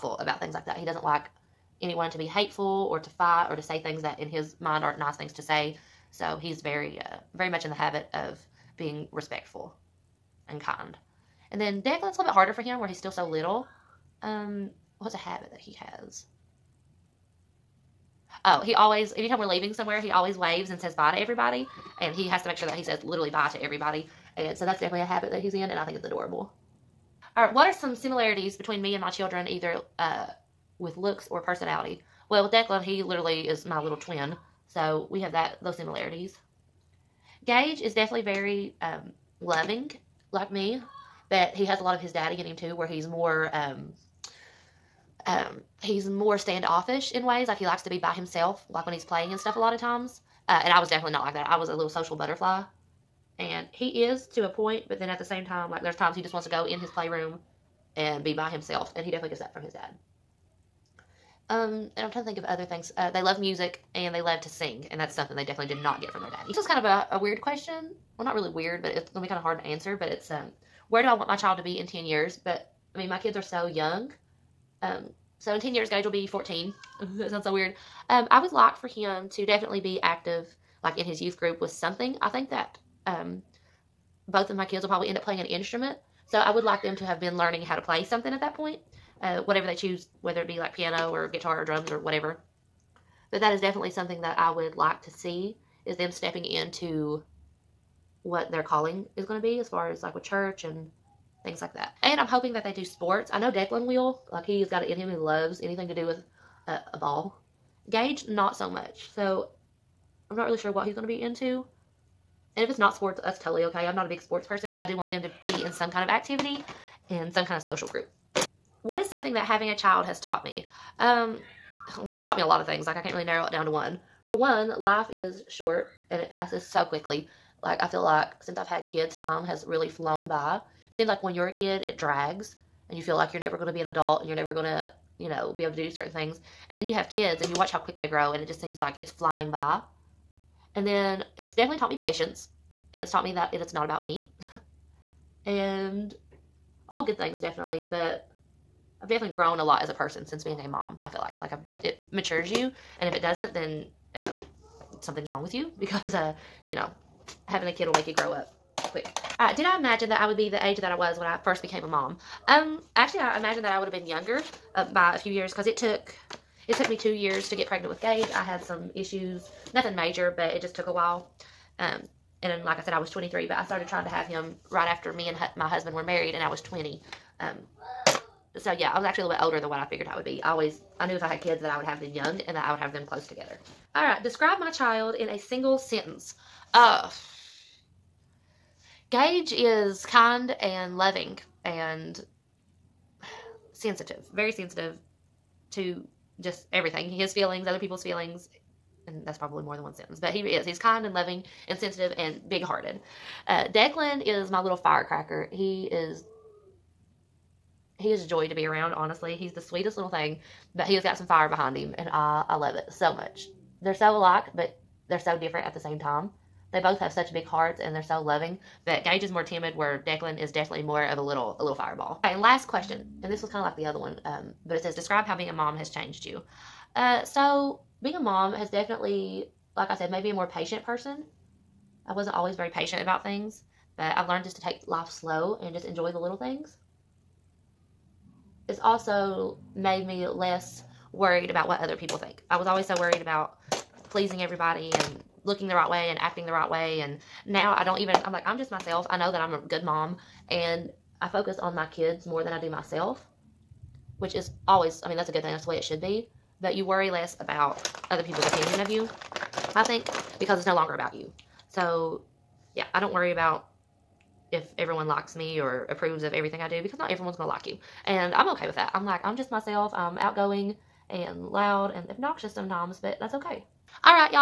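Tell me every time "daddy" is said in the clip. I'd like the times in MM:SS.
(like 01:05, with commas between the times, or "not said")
00:42, 01:06.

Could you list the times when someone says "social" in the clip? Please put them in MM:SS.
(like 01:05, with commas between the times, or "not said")
00:51, 01:57.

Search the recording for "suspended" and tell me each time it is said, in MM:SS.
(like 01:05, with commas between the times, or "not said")
not said.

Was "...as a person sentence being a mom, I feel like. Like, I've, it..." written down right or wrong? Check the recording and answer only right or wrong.
wrong.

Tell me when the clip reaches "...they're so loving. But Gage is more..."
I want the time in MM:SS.
03:37.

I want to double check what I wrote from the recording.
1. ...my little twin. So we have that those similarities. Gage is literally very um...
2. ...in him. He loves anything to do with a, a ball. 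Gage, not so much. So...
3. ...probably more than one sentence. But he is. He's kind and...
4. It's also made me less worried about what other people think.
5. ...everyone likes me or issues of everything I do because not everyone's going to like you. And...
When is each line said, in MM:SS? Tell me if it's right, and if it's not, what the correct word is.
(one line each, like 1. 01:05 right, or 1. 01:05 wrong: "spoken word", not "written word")
1. 00:33 wrong: "definitely", not "literally"
2. 01:44 right
3. 03:19 right
4. 03:58 right
5. 04:24 wrong: "approves", not "issues".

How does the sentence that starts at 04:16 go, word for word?
But you worry less about other people's opinion of you, I think, because it's no longer about you.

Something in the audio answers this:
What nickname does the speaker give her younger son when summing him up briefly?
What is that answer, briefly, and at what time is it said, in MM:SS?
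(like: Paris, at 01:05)
firecracker, at 03:24.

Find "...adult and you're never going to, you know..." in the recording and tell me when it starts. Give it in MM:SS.
02:13.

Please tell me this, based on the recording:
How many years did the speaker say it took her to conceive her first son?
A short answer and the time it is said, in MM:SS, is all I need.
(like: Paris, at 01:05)
2, at 02:46.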